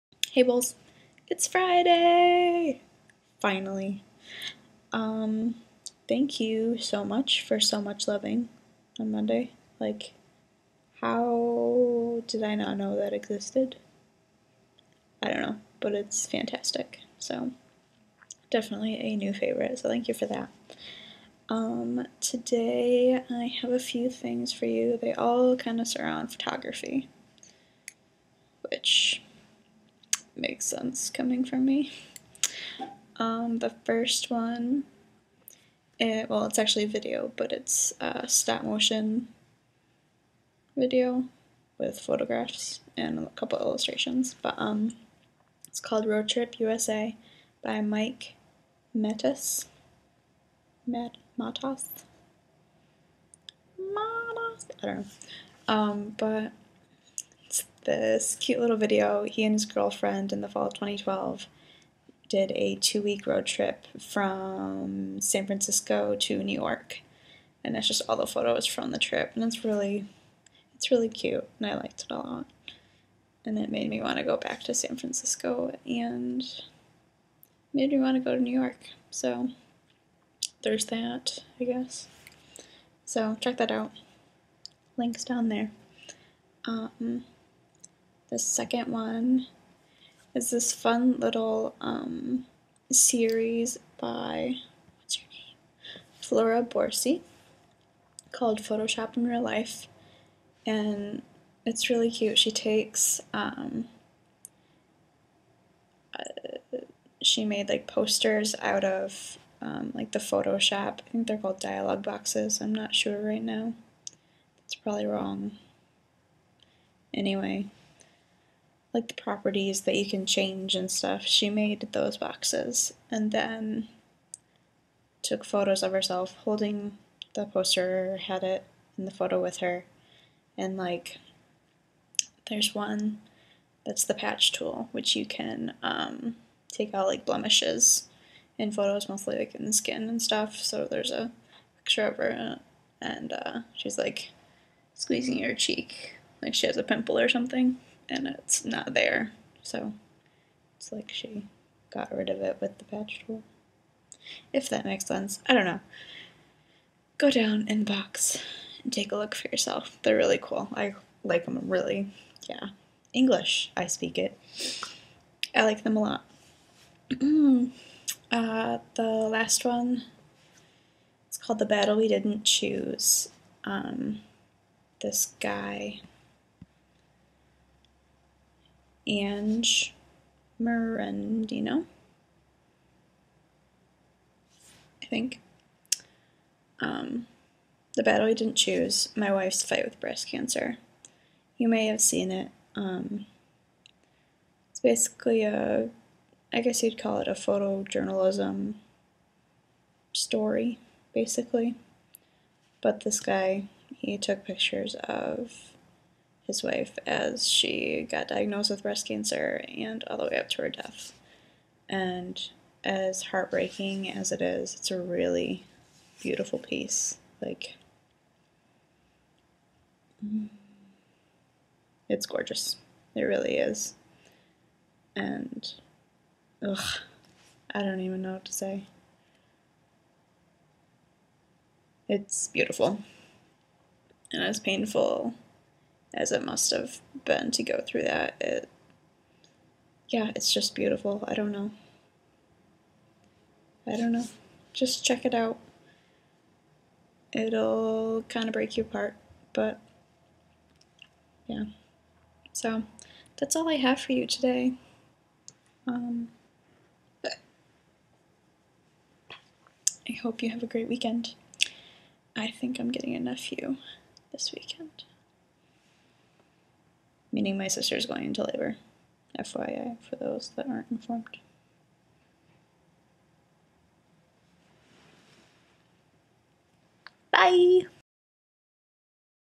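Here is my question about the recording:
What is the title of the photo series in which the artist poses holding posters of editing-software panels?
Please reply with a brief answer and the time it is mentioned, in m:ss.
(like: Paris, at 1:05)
Photoshop in Real Life, at 1:38.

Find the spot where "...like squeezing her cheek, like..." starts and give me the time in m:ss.
2:23.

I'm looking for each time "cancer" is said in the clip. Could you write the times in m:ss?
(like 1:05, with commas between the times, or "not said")
3:10, 3:29.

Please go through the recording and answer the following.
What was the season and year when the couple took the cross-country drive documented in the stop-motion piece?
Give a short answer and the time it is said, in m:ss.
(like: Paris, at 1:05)
fall of 2012, at 1:00.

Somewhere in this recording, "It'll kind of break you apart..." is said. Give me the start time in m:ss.
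4:07.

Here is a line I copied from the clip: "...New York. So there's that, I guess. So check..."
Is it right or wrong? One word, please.
right.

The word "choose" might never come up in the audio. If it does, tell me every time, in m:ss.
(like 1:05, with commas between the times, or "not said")
2:52, 3:08.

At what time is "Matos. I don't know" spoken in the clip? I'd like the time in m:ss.
0:53.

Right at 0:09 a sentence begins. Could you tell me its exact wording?
Like, how did I not know that existed?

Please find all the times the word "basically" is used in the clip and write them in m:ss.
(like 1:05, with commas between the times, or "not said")
3:14, 3:21.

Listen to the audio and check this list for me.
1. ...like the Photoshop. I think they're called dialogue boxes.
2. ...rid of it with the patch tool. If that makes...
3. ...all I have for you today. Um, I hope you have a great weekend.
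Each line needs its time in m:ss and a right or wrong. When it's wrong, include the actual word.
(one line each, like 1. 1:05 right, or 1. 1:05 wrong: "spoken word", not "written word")
1. 1:49 right
2. 2:32 right
3. 4:13 right.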